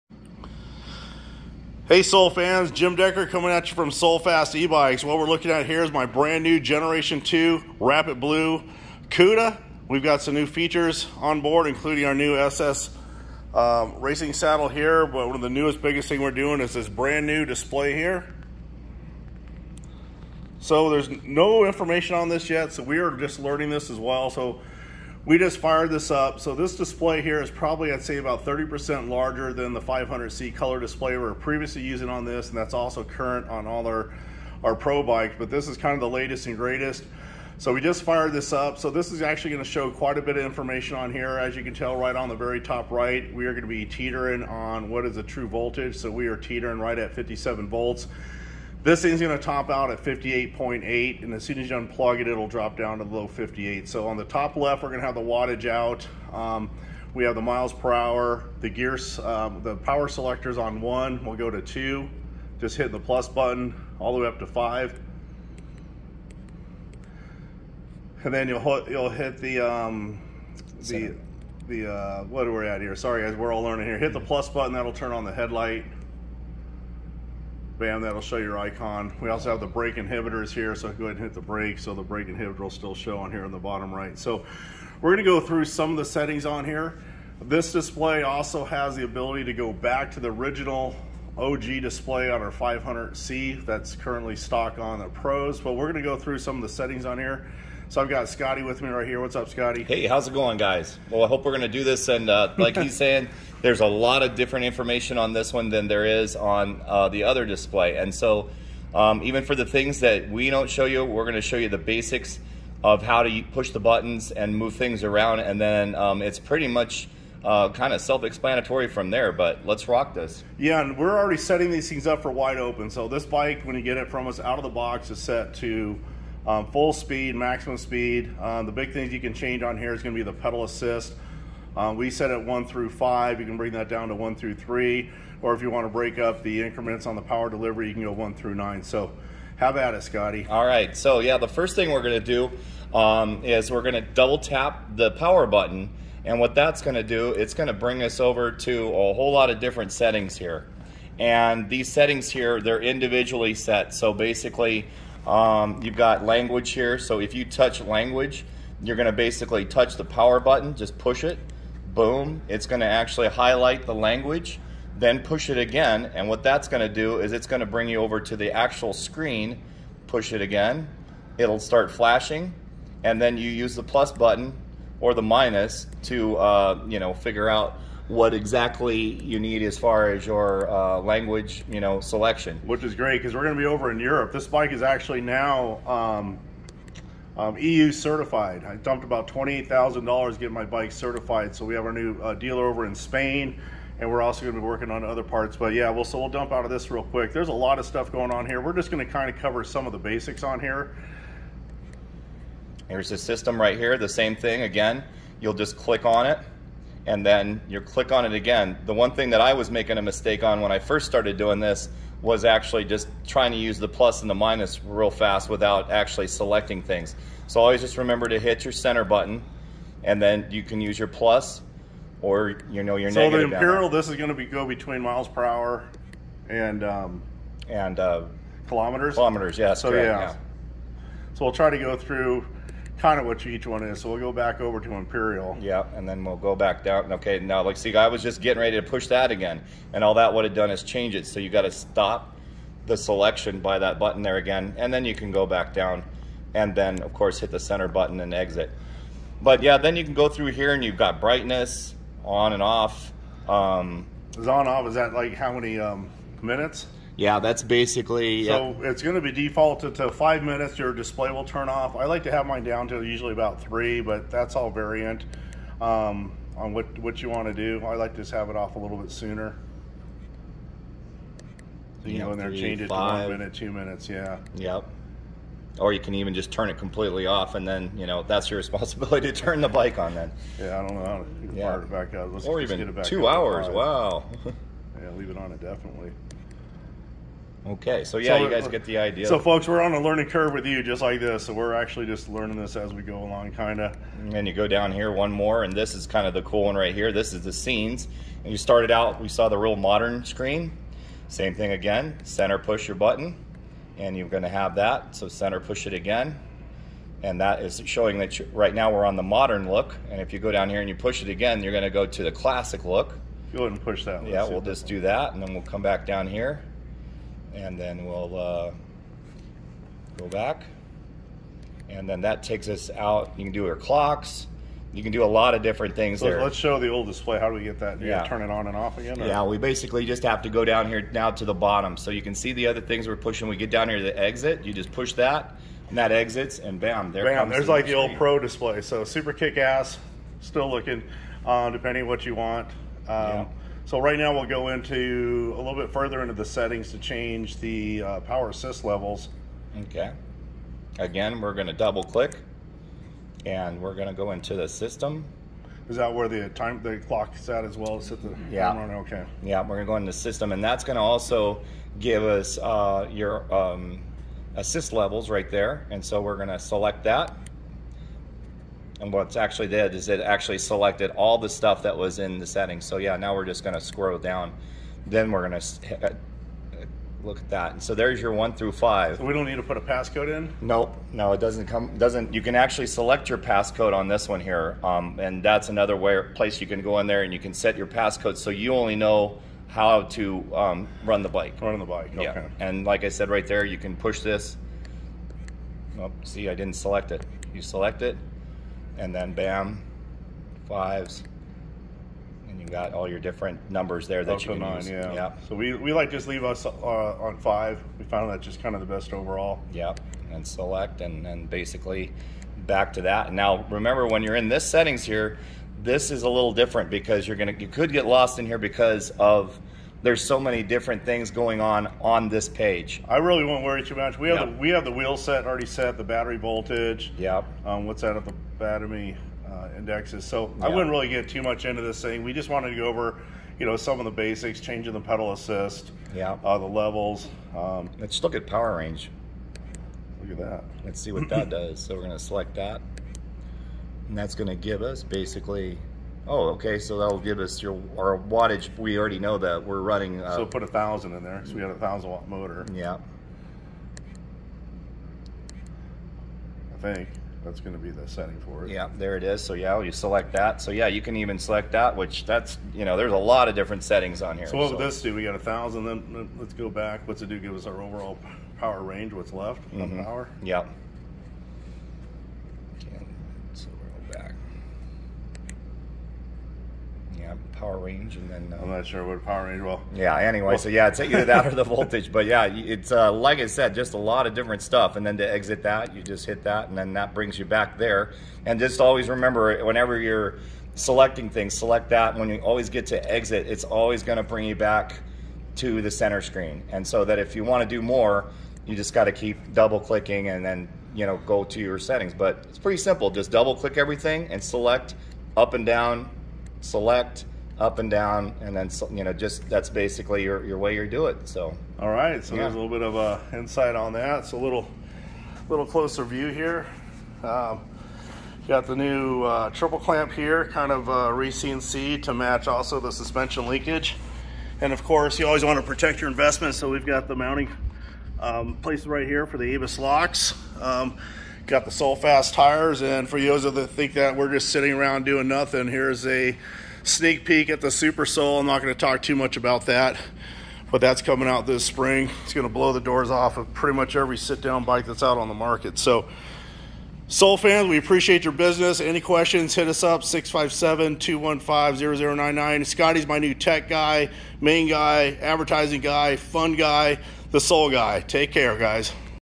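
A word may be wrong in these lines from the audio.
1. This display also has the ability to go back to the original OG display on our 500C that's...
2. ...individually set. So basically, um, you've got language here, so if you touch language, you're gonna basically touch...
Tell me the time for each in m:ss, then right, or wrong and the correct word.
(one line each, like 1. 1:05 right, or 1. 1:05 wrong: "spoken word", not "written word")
1. 1:27 right
2. 2:32 right.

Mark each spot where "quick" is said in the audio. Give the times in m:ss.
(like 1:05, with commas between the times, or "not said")
3:17.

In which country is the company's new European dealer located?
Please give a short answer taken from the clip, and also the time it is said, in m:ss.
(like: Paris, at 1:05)
Spain, at 3:12.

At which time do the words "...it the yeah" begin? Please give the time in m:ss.
5:58.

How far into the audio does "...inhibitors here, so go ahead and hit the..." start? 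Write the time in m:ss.
1:19.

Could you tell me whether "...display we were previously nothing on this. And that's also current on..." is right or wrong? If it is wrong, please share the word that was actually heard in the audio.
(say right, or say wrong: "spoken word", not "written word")
wrong: "using", not "nothing".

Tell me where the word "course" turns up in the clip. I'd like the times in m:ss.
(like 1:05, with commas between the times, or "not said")
4:07, 8:44.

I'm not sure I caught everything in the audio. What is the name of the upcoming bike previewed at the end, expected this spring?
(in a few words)
Super Soul.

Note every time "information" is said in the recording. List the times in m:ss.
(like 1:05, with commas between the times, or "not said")
0:21, 0:40, 1:44.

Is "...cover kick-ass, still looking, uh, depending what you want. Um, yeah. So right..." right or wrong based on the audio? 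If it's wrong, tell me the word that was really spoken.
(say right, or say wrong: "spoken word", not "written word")
wrong: "super", not "cover".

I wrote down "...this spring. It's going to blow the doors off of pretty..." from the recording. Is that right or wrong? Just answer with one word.
right.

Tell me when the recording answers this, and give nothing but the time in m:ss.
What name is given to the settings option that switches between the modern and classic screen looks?
4:57.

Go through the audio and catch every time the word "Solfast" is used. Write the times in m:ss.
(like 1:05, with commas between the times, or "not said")
8:51.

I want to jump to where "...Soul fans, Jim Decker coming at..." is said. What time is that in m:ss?
0:02.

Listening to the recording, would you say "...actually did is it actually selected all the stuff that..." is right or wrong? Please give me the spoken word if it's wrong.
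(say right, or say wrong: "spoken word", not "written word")
right.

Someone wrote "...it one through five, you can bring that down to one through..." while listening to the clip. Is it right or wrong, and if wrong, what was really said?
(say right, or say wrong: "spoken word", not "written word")
right.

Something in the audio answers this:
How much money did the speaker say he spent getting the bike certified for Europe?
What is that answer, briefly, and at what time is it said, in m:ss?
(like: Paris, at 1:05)
$28,000, at 3:09.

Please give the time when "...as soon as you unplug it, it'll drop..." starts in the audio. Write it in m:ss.
0:51.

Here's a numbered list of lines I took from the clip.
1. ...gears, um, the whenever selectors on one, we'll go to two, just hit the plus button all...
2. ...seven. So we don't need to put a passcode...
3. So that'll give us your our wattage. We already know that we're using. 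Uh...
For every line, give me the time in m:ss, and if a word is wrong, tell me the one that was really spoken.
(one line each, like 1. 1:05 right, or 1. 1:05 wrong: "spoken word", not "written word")
1. 0:58 wrong: "power", not "whenever"
2. 6:18 wrong: "five", not "seven"
3. 7:26 wrong: "running", not "using".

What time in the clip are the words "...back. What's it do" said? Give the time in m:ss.
7:46.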